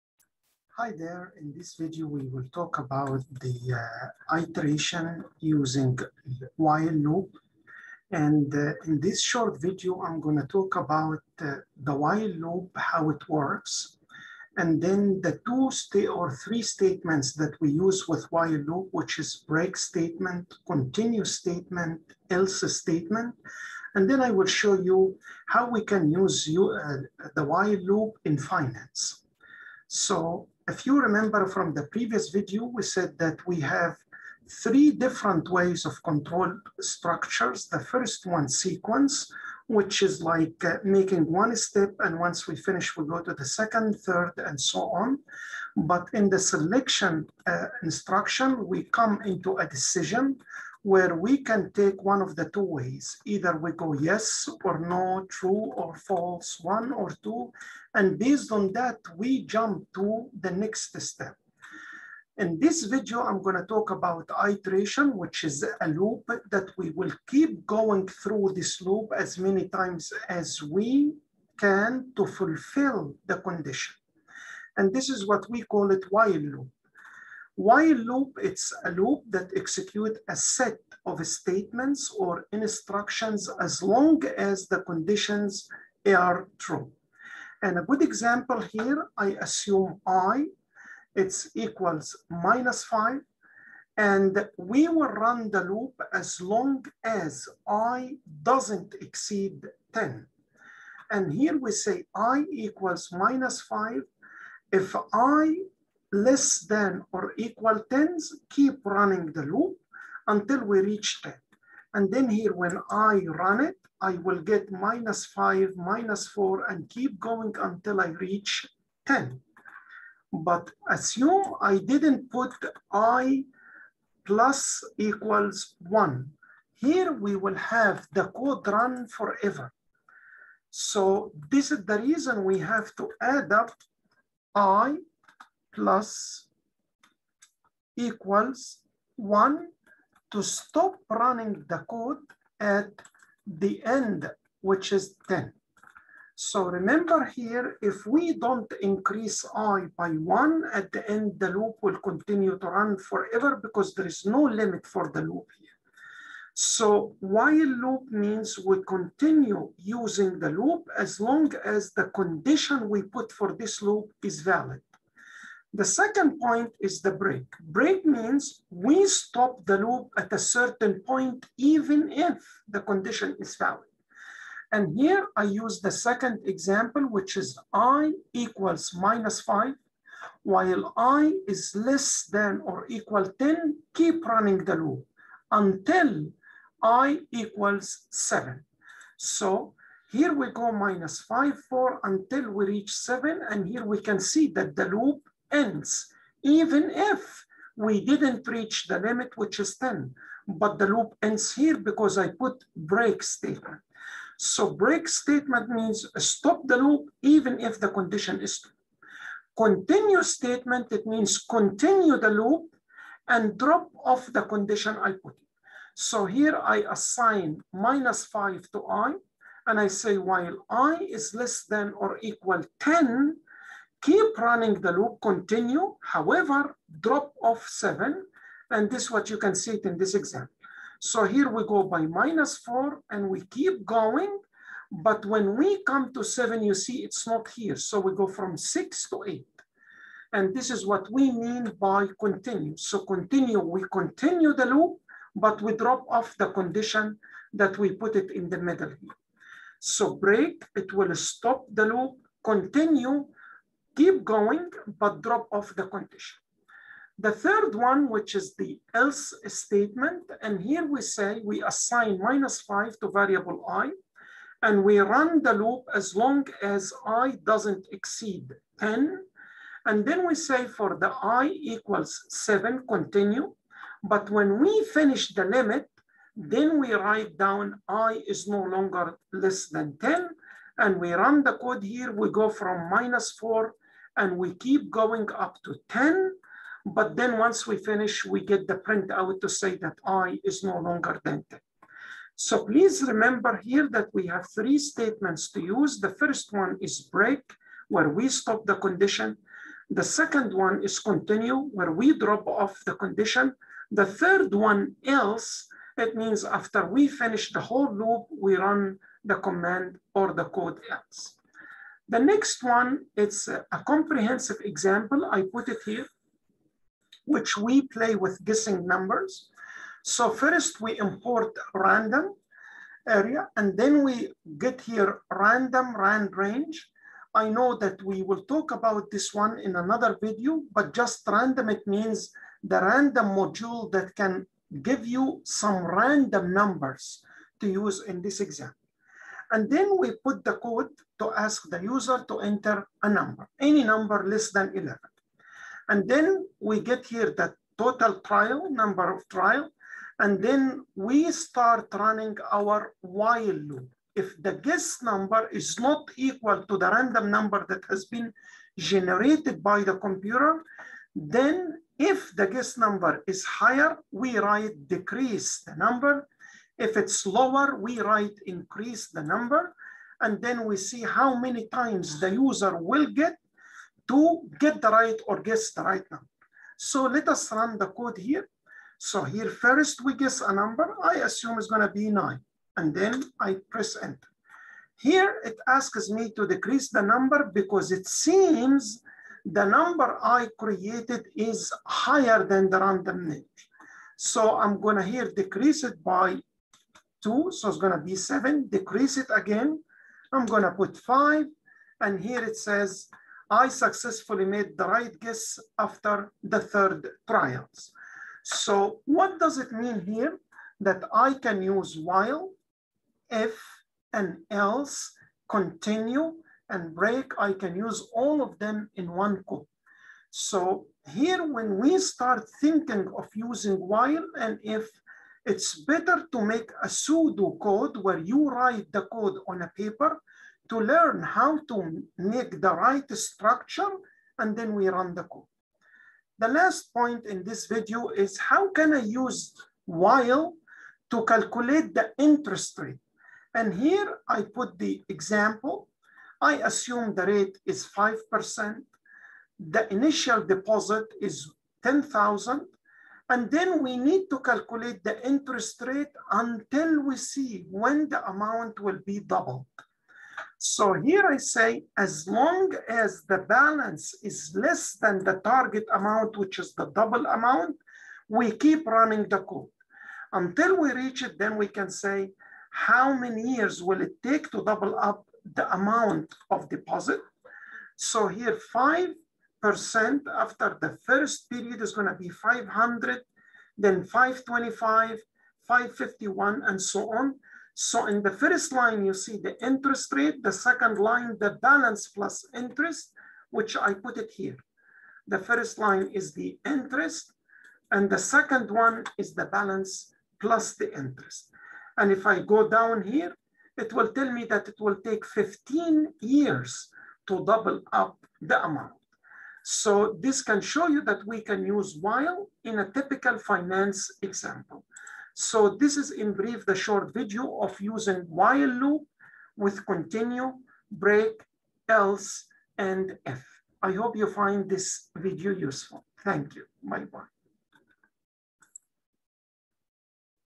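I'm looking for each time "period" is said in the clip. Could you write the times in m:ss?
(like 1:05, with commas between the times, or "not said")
8:01.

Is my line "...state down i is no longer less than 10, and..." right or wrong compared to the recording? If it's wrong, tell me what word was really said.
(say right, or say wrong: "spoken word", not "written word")
wrong: "write", not "state".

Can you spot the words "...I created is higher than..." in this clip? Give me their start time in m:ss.
6:30.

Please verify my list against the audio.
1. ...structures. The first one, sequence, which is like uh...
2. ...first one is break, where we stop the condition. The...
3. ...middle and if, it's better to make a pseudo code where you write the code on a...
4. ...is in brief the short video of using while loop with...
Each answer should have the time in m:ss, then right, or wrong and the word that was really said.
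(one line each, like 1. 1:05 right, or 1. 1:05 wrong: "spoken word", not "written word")
1. 0:36 right
2. 4:56 right
3. 7:03 wrong: "while", not "middle"
4. 8:35 right.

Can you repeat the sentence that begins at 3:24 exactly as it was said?
So break statement means stop the loop even if the condition is true.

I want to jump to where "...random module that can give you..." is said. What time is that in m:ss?
5:32.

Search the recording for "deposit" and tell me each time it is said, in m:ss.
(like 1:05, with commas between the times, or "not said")
7:30, 7:56.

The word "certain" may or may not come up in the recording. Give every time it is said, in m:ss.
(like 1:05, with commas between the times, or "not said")
2:50.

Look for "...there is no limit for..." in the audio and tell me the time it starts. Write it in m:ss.
2:33.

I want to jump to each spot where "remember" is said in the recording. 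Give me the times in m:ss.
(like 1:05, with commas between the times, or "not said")
0:31, 2:26, 4:53.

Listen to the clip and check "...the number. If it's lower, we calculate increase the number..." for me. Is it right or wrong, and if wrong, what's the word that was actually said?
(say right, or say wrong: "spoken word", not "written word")
wrong: "write", not "calculate".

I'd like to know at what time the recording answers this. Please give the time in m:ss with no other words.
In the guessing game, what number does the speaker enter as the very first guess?
6:22.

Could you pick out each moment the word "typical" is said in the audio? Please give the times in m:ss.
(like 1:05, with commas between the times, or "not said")
8:32.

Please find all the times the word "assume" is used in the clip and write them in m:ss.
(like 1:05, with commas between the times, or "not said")
1:29, 2:00, 6:21, 7:26.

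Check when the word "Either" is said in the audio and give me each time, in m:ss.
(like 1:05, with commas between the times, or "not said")
0:53.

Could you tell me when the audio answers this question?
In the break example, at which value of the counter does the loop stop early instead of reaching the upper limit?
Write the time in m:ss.
3:05.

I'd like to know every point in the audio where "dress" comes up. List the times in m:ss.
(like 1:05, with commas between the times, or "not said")
not said.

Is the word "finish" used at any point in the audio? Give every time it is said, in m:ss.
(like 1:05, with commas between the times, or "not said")
0:42, 4:34, 4:47, 5:07.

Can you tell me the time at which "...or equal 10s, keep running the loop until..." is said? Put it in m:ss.
1:47.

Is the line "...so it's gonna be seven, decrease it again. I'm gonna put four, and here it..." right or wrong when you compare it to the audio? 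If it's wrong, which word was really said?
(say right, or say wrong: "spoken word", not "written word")
wrong: "five", not "four".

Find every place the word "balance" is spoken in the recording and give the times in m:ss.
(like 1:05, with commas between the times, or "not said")
7:43, 8:11, 8:19.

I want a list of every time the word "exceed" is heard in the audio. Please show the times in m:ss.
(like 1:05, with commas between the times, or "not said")
1:39, 4:27.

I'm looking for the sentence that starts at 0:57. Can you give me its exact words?
And based on that, we jump to the next step.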